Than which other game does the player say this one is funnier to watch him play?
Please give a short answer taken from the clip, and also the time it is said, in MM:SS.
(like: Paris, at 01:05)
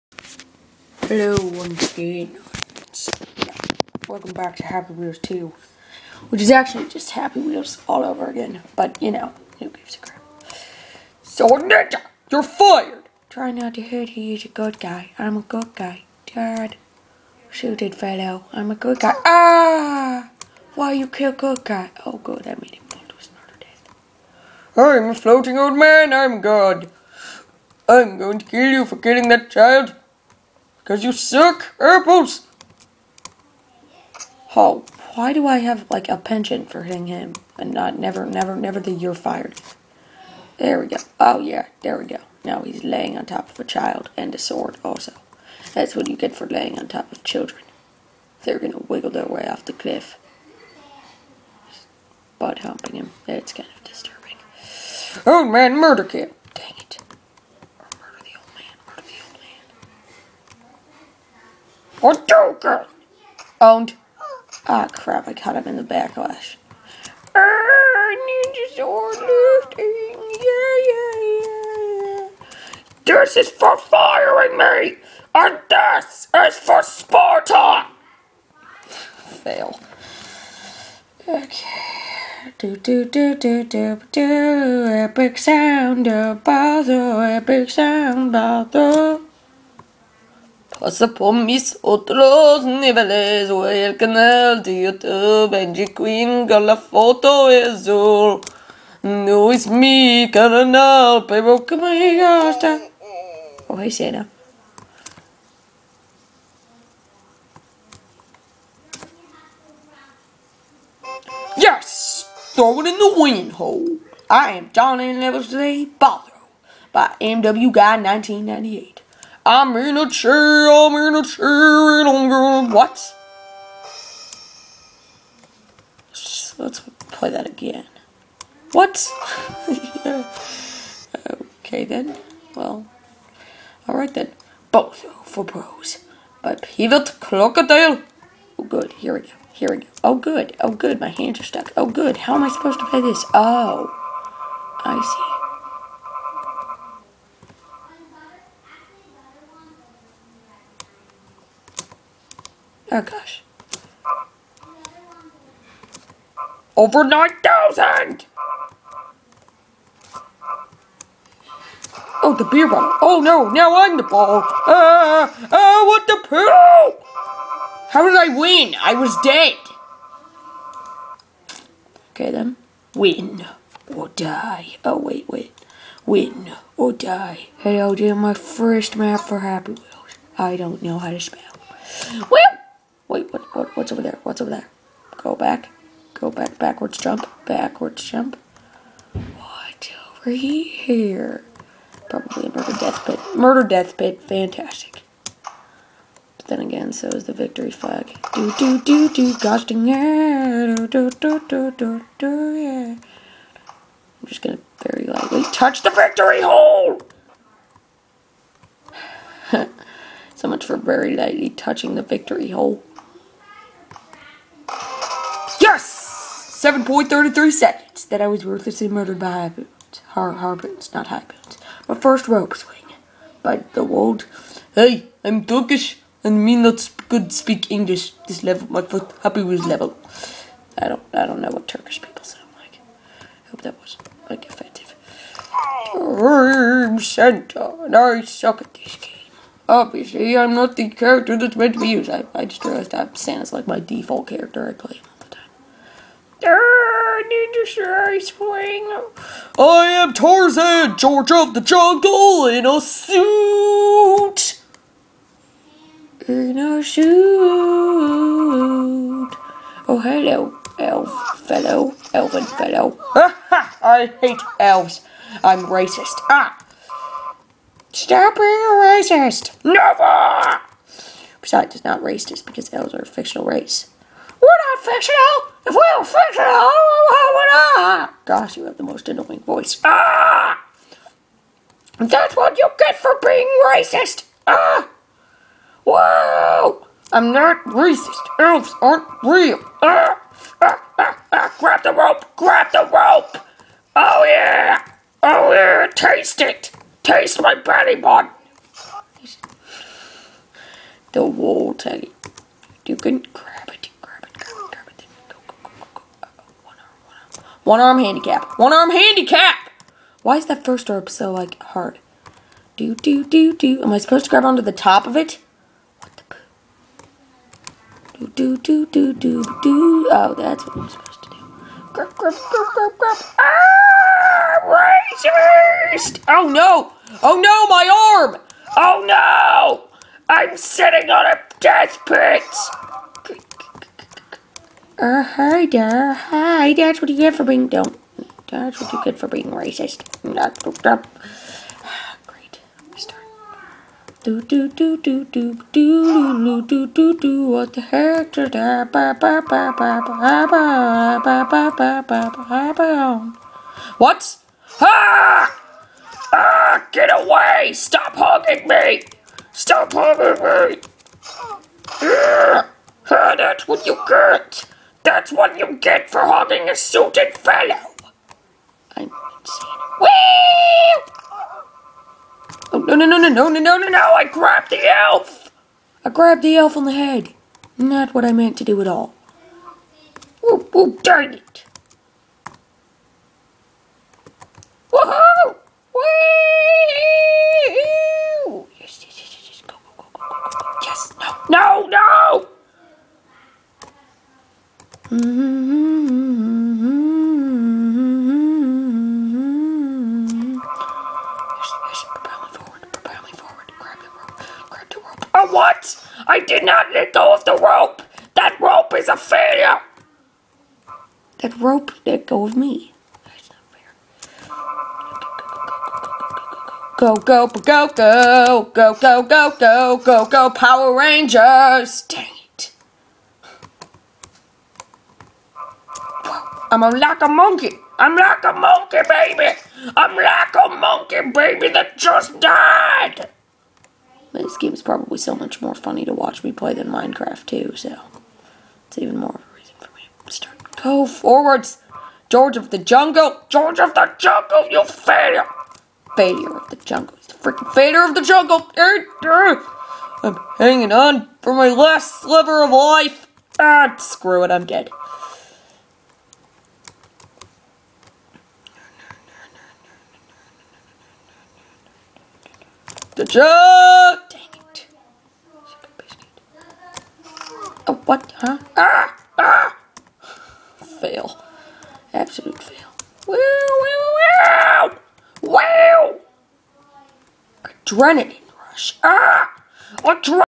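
Minecraft, at 07:16.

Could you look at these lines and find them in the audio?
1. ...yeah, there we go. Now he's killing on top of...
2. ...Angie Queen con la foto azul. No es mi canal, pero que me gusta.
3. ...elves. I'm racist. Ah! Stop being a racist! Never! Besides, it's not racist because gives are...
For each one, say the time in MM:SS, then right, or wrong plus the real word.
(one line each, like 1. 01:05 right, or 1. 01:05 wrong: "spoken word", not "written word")
1. 00:41 wrong: "laying", not "killing"
2. 01:35 right
3. 04:24 wrong: "elves", not "gives".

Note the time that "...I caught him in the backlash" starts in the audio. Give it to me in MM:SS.
01:05.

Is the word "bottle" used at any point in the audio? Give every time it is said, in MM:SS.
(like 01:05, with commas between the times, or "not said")
02:42.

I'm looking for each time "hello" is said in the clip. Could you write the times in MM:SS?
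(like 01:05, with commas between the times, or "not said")
00:01, 04:20.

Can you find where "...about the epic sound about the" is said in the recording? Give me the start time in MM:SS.
01:26.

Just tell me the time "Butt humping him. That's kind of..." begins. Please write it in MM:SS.
00:52.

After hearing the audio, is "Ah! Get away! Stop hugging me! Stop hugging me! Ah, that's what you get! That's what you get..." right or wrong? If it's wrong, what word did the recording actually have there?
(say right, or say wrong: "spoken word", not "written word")
right.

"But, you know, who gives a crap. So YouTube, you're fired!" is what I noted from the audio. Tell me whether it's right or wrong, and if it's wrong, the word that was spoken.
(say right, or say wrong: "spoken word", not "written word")
wrong: "Ninja", not "YouTube".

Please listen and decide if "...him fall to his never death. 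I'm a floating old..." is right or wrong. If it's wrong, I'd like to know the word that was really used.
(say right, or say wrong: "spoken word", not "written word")
wrong: "murder", not "never".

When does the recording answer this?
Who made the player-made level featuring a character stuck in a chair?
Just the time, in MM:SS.
01:57.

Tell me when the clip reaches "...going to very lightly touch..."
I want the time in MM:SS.
03:24.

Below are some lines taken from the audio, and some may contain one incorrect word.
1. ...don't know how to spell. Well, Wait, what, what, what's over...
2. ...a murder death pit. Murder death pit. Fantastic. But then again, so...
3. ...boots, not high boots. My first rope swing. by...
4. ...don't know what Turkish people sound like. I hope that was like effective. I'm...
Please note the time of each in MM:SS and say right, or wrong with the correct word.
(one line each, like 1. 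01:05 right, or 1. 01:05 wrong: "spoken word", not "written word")
1. 03:00 right
2. 03:12 right
3. 03:40 right
4. 03:51 right.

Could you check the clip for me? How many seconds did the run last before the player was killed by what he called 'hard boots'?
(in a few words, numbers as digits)
7.33.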